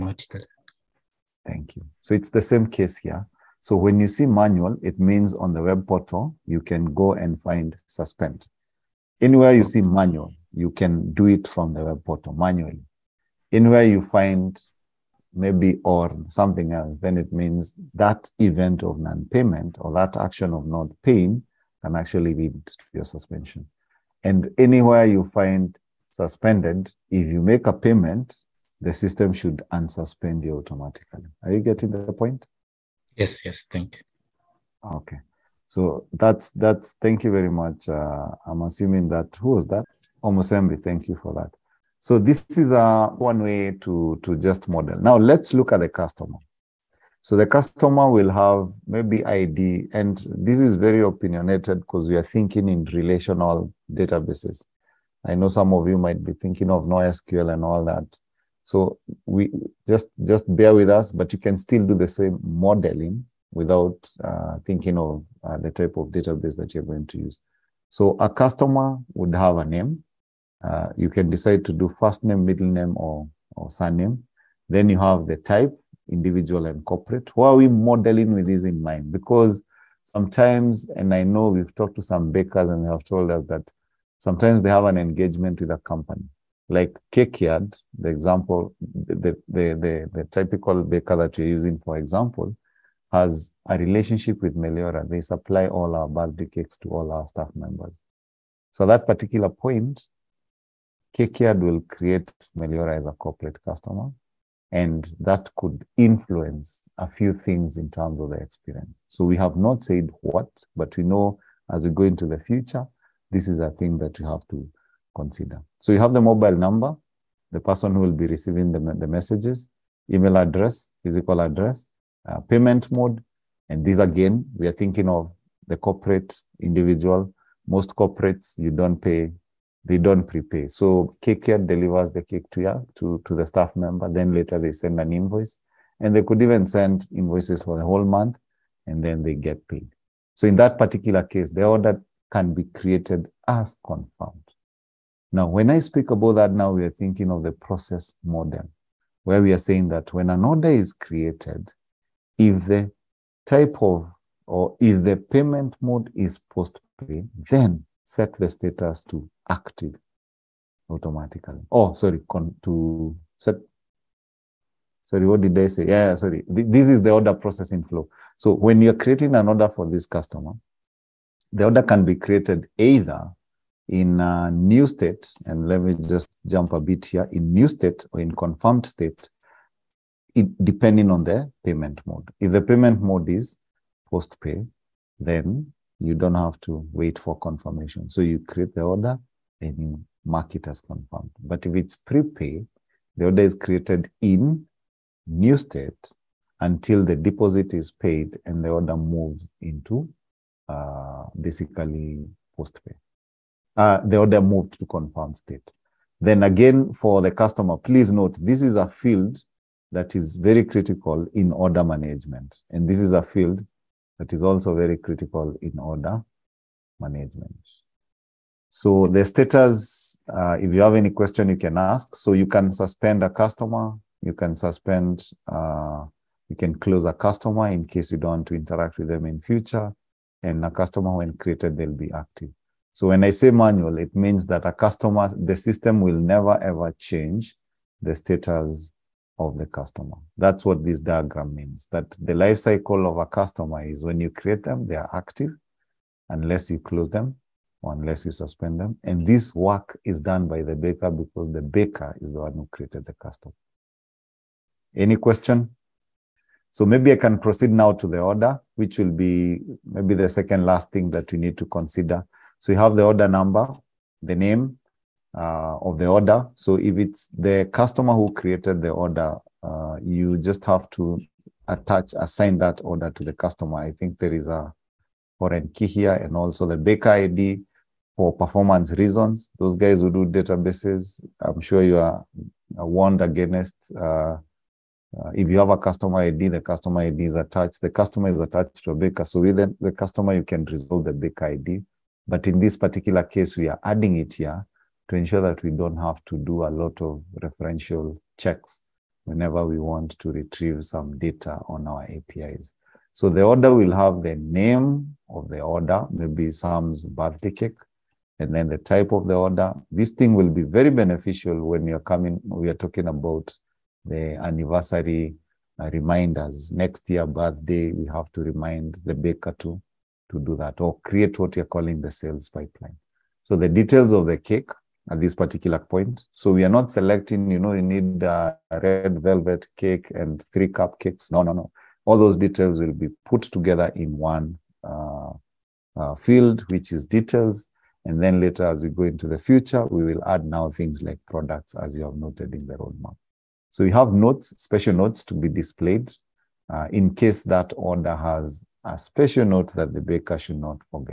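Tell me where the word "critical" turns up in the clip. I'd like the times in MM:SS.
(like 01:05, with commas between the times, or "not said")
03:30, 03:34.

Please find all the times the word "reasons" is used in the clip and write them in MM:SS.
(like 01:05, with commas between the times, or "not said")
04:38.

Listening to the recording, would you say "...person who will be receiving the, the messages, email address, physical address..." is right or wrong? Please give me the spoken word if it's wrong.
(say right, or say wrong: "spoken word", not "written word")
right.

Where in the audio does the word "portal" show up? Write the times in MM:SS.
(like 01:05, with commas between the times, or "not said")
00:05, 00:12.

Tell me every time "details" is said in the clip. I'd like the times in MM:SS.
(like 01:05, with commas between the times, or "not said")
05:23, 05:32, 05:37.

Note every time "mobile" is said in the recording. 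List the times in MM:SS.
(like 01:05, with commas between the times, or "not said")
01:56.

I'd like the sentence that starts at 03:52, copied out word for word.
So when I say manual, it means that a customer, the system will never ever change the status of the customer.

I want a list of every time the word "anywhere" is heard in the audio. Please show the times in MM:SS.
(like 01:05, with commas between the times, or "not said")
00:09, 00:13, 00:24.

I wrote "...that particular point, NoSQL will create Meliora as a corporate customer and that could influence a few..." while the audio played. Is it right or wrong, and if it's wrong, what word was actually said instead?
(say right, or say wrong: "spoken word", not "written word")
wrong: "Cakeyard", not "NoSQL".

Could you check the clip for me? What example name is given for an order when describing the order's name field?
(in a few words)
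Sam's birthday cake.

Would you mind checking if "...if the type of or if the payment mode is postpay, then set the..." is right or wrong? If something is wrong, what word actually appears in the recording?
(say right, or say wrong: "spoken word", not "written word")
right.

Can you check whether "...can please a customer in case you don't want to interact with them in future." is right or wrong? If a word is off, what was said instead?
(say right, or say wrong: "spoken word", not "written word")
wrong: "close", not "please".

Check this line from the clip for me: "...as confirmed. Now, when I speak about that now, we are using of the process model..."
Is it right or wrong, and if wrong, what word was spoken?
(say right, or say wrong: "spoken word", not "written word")
wrong: "thinking", not "using".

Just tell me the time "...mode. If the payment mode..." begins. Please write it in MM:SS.
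03:02.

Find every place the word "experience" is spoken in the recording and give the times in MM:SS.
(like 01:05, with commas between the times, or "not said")
01:48.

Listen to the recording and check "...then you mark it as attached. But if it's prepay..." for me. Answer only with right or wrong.
wrong.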